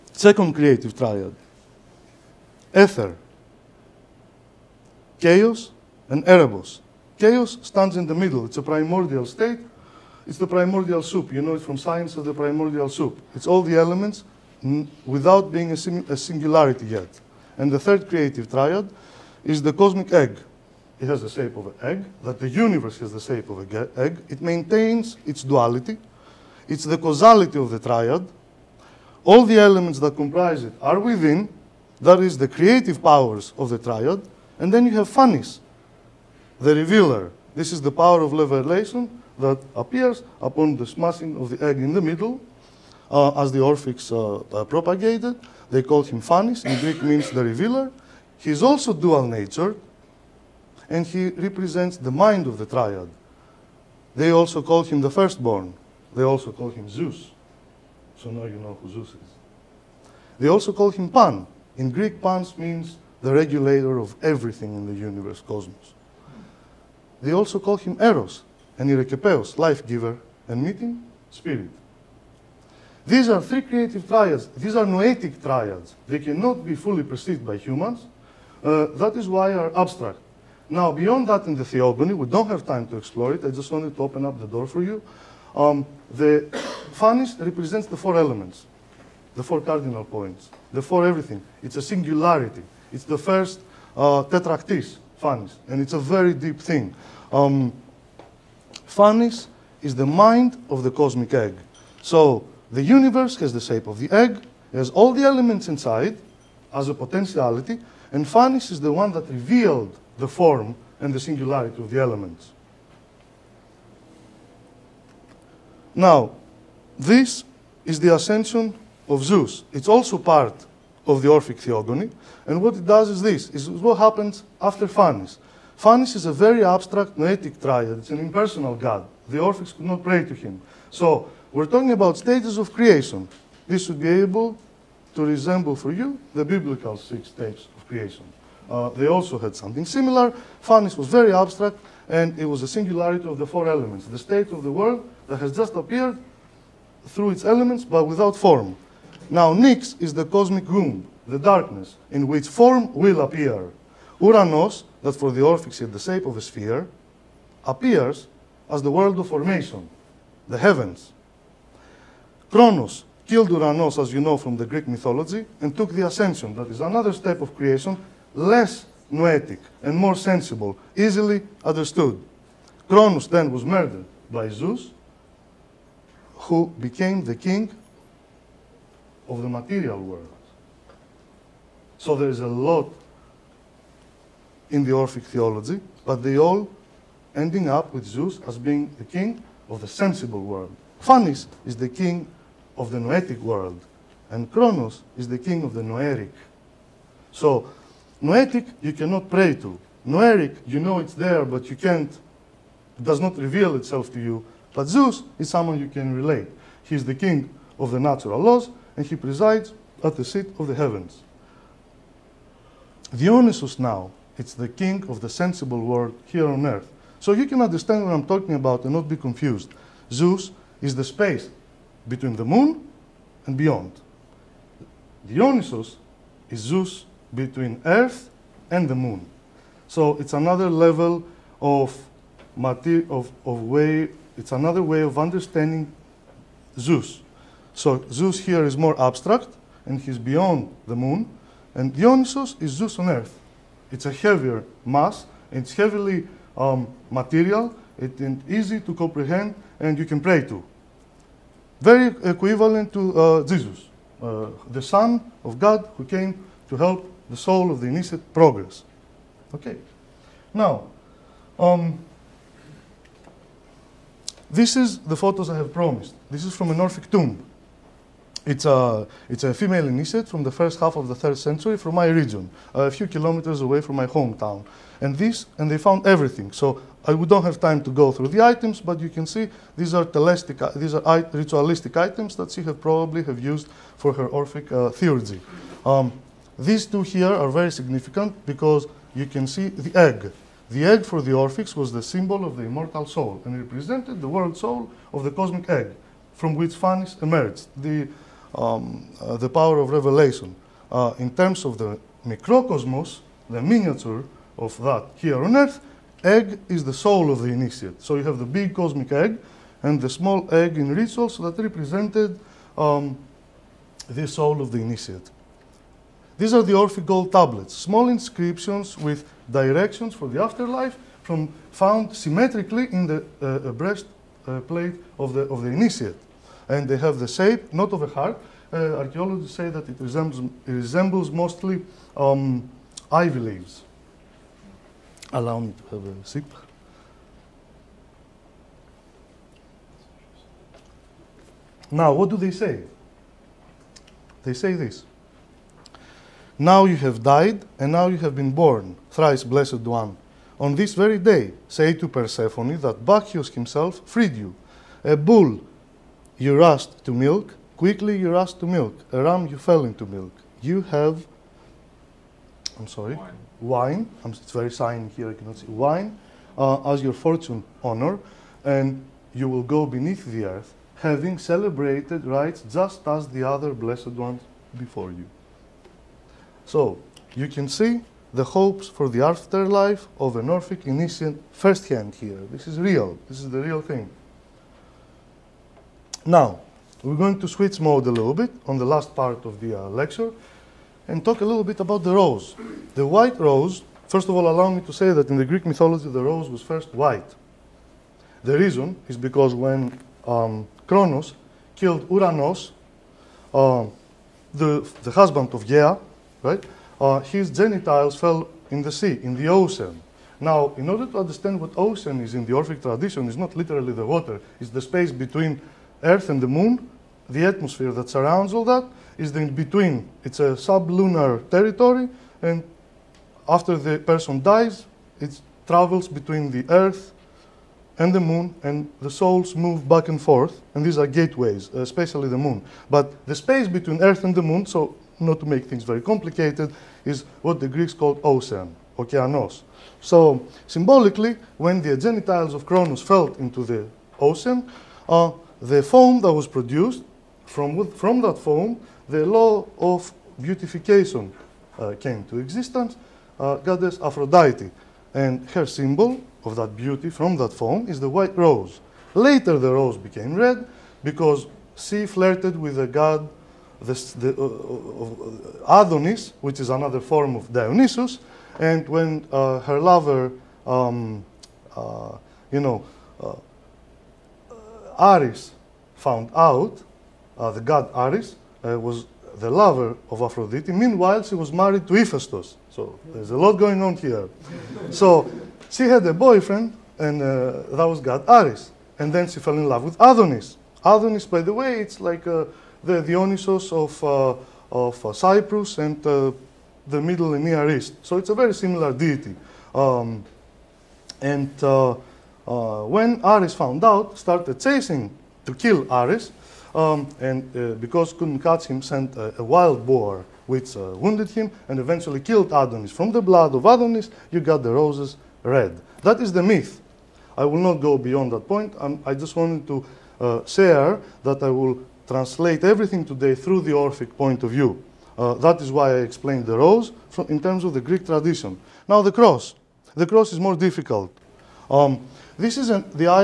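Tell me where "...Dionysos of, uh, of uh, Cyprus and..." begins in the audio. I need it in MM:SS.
08:13.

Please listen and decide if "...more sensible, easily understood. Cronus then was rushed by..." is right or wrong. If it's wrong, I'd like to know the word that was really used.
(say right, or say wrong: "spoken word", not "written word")
wrong: "murdered", not "rushed".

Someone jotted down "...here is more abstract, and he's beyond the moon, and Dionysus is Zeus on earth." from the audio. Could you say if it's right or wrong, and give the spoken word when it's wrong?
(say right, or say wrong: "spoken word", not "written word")
right.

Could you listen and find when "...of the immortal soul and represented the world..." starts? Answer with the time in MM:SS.
04:52.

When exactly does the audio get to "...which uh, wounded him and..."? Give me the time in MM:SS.
08:30.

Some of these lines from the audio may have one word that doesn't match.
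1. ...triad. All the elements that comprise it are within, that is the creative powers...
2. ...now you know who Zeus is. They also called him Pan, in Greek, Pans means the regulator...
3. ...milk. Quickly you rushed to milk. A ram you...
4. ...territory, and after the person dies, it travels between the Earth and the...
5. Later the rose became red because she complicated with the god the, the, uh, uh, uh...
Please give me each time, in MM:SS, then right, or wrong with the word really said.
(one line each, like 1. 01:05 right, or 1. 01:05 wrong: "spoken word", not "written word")
1. 00:27 right
2. 00:58 right
3. 05:57 right
4. 07:01 right
5. 07:39 wrong: "flirted", not "complicated".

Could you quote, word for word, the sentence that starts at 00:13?
It's all the elements without being a, a singularity yet.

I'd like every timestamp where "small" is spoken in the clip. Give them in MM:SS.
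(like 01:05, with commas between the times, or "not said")
05:10, 05:17.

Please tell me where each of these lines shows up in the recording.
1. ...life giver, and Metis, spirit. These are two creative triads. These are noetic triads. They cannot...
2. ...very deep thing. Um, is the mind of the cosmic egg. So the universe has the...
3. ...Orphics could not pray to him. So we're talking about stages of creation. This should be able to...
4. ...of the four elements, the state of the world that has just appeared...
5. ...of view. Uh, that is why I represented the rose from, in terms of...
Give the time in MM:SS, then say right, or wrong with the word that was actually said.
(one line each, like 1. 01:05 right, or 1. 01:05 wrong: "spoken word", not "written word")
1. 01:09 wrong: "three", not "two"
2. 01:35 right
3. 02:09 right
4. 02:23 right
5. 08:44 wrong: "explained", not "represented".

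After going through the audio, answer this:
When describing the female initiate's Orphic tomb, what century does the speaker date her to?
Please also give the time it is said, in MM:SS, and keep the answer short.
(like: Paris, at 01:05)
Third century, at 04:31.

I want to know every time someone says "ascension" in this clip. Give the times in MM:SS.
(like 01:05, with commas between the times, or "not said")
01:58, 02:46.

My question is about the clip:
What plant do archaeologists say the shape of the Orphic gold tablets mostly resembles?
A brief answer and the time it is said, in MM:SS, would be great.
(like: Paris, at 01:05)
Ivy leaves, at 05:33.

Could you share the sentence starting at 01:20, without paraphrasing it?
Now, beyond that in the theogony, we don't have time to explore it.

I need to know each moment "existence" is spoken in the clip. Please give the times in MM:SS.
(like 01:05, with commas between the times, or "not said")
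07:32.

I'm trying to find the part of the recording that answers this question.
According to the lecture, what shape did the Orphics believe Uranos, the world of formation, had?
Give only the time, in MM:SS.
02:36.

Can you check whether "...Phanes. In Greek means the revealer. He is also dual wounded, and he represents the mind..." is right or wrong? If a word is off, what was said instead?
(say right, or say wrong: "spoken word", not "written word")
wrong: "natured", not "wounded".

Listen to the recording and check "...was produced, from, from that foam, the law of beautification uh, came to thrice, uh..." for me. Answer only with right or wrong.
wrong.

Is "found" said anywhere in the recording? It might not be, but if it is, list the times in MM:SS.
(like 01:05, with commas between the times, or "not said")
04:35, 05:21, 07:55, 08:23.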